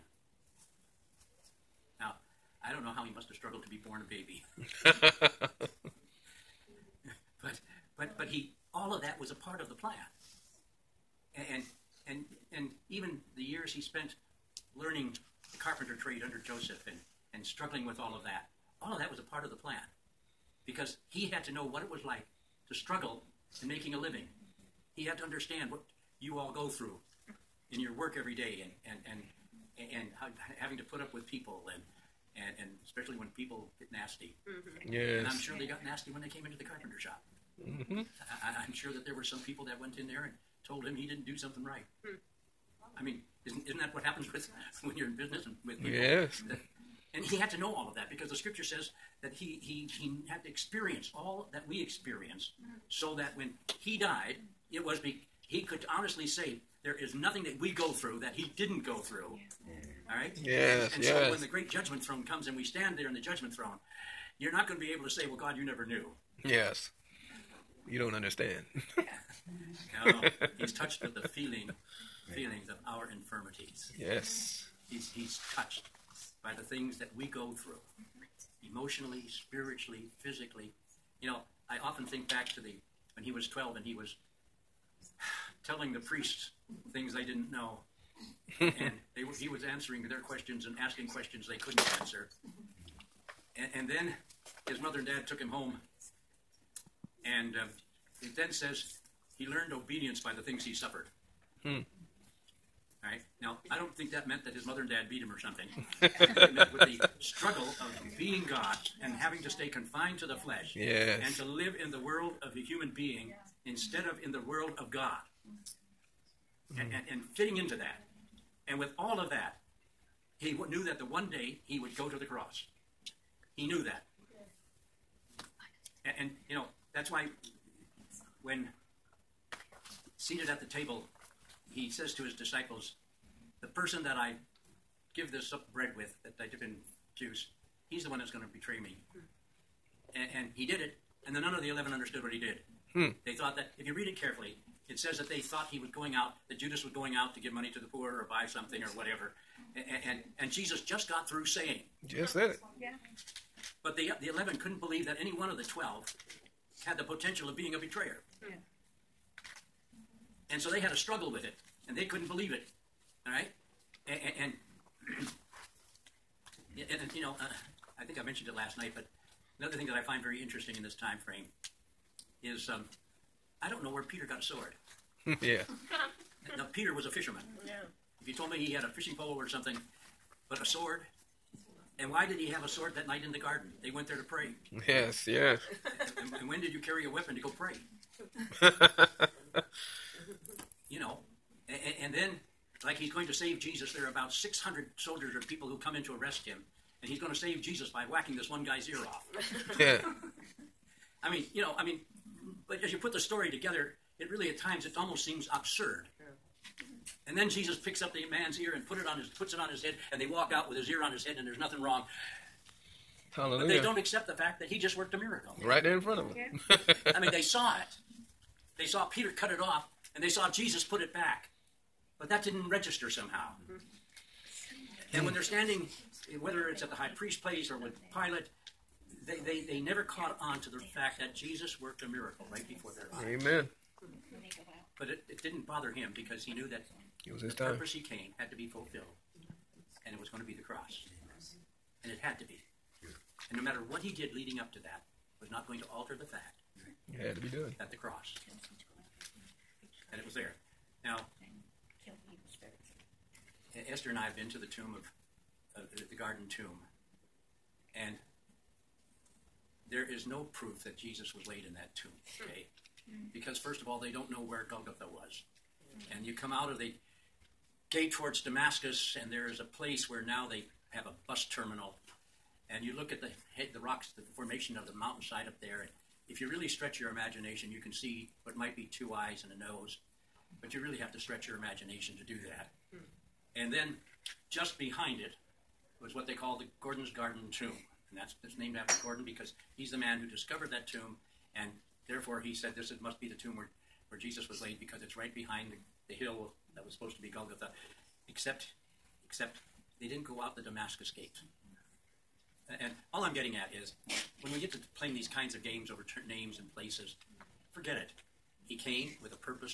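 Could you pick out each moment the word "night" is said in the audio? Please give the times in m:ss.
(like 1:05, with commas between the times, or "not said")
2:48, 3:03.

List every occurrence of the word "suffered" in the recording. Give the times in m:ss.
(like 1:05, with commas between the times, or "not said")
1:40.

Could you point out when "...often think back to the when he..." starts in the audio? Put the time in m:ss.
1:21.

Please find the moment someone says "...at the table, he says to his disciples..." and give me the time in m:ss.
2:10.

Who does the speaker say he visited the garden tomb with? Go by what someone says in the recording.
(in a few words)
Esther.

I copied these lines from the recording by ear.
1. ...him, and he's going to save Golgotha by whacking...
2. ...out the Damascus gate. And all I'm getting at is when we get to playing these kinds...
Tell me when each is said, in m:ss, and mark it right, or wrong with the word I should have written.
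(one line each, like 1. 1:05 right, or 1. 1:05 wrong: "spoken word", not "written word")
1. 3:16 wrong: "Jesus", not "Golgotha"
2. 5:00 right.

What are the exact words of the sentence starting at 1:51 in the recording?
and to live in the world of a human being instead of in the world of God.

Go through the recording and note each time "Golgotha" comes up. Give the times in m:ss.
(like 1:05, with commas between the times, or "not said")
4:24, 4:57.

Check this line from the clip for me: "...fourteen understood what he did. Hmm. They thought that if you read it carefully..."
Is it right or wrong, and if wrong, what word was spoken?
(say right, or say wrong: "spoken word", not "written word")
wrong: "eleven", not "fourteen".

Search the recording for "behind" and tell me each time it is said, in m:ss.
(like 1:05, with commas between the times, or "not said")
4:44, 4:55.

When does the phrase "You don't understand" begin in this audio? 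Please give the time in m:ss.
1:07.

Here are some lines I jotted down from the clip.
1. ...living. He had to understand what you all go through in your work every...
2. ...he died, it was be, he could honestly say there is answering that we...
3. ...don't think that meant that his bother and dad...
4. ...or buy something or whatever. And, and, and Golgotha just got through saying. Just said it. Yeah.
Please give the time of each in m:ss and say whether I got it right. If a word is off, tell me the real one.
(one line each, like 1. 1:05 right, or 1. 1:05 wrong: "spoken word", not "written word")
1. 0:23 right
2. 0:53 wrong: "nothing", not "answering"
3. 1:43 wrong: "mother", not "bother"
4. 2:28 wrong: "Jesus", not "Golgotha".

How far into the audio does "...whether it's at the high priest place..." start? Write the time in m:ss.
3:46.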